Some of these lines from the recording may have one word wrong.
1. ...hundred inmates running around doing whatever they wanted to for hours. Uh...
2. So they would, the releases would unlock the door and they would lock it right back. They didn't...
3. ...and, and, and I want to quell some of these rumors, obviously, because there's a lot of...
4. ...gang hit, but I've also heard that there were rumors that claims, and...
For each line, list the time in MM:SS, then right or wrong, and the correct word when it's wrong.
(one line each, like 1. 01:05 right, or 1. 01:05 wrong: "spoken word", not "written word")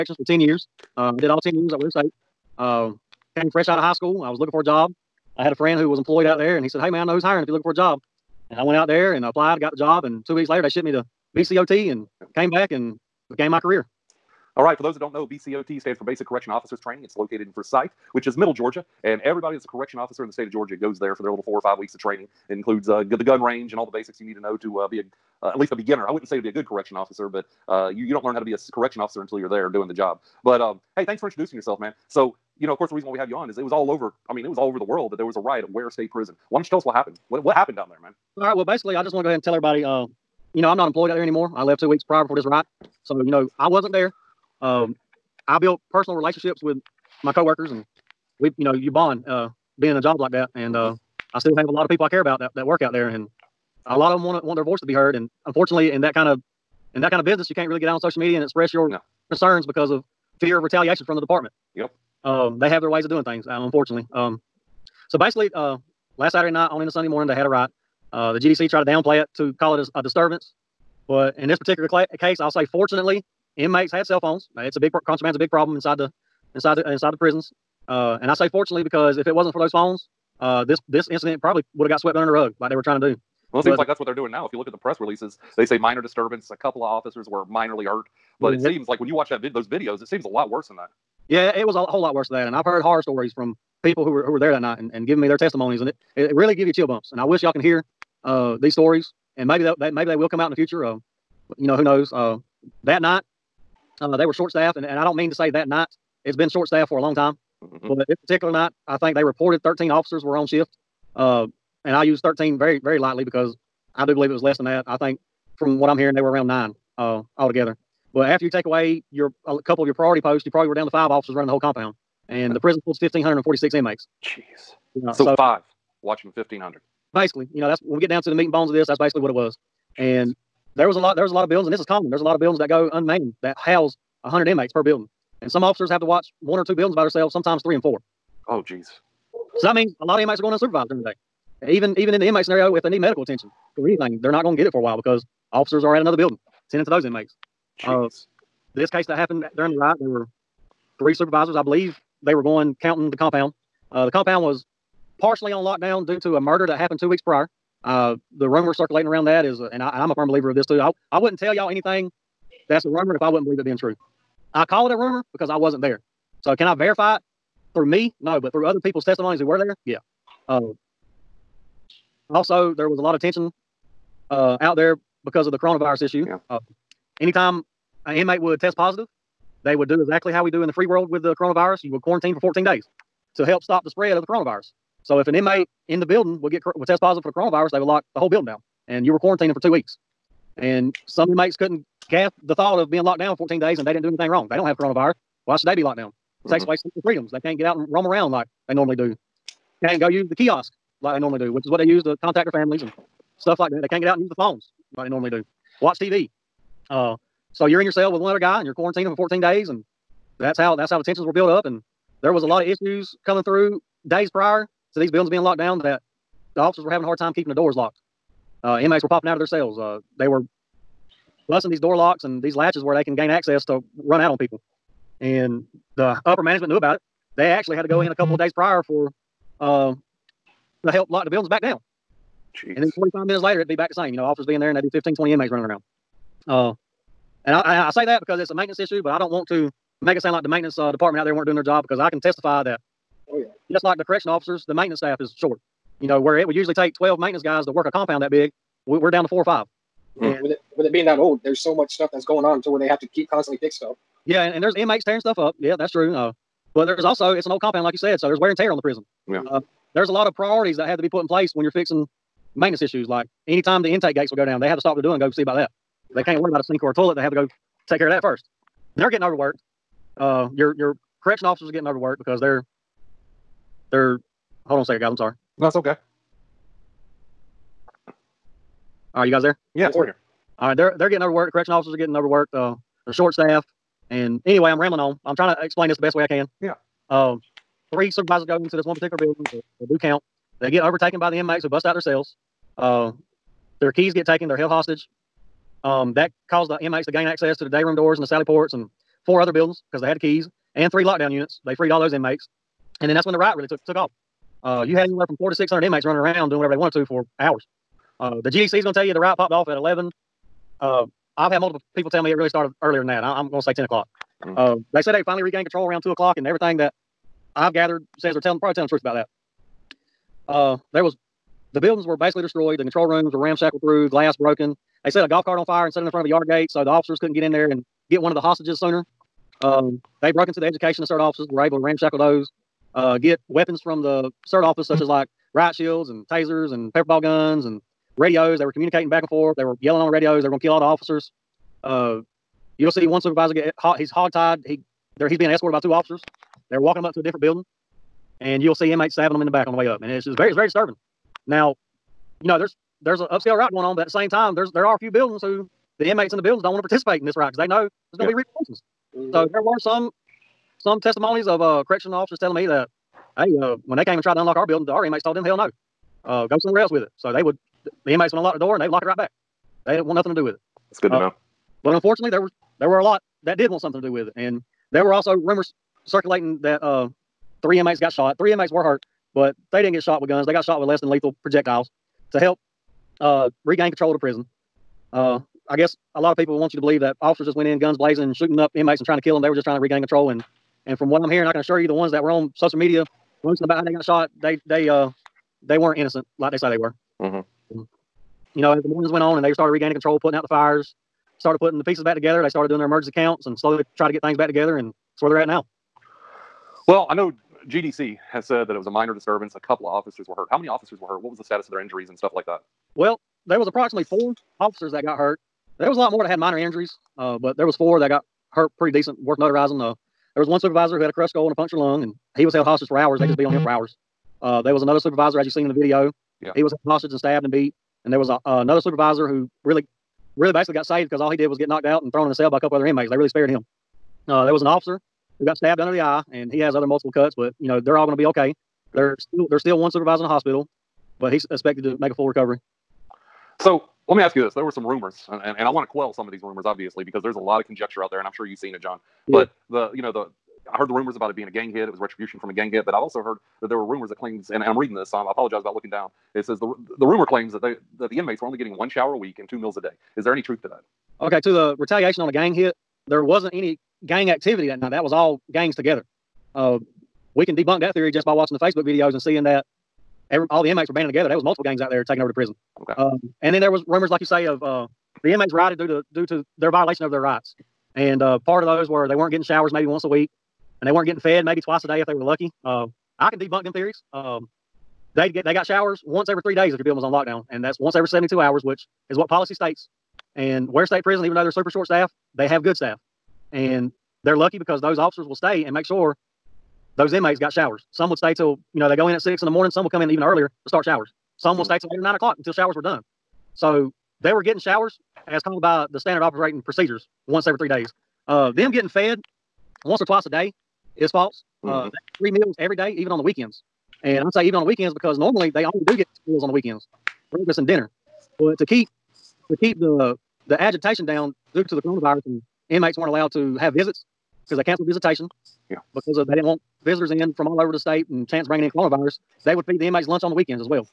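1. 05:05 right
2. 06:07 wrong: "inmates", not "releases"
3. 07:25 right
4. 07:32 right.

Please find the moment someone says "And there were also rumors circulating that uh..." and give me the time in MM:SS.
06:14.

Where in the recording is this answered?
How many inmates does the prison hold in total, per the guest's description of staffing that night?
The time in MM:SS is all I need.
02:03.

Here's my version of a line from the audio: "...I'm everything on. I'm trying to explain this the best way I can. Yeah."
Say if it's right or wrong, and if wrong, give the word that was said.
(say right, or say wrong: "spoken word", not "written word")
wrong: "rambling", not "everything".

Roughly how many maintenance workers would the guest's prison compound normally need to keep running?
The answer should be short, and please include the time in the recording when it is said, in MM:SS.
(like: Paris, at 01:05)
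12, at 04:06.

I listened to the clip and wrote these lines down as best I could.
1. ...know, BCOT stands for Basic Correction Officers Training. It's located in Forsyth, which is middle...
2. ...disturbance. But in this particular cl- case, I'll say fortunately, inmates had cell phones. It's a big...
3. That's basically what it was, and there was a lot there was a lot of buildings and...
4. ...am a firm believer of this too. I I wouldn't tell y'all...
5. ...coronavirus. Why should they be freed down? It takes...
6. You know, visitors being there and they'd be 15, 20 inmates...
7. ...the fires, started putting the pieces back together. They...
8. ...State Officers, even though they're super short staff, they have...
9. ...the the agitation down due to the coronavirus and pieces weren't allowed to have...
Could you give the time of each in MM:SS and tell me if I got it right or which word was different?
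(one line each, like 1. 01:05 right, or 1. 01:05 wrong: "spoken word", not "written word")
1. 00:15 right
2. 01:10 right
3. 02:08 right
4. 02:40 right
5. 03:14 wrong: "locked", not "freed"
6. 03:54 wrong: "officers", not "visitors"
7. 06:40 right
8. 08:10 wrong: "Prison", not "Officers"
9. 08:39 wrong: "inmates", not "pieces".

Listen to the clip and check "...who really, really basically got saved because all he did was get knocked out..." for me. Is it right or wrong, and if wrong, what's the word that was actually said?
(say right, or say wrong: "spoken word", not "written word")
right.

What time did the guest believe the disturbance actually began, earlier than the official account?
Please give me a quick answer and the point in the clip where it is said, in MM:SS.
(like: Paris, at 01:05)
10 o'clock, at 05:13.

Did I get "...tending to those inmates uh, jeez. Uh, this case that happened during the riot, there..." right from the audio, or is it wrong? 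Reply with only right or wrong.
right.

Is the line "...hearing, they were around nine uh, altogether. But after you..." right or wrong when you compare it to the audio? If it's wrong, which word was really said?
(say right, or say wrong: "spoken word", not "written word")
right.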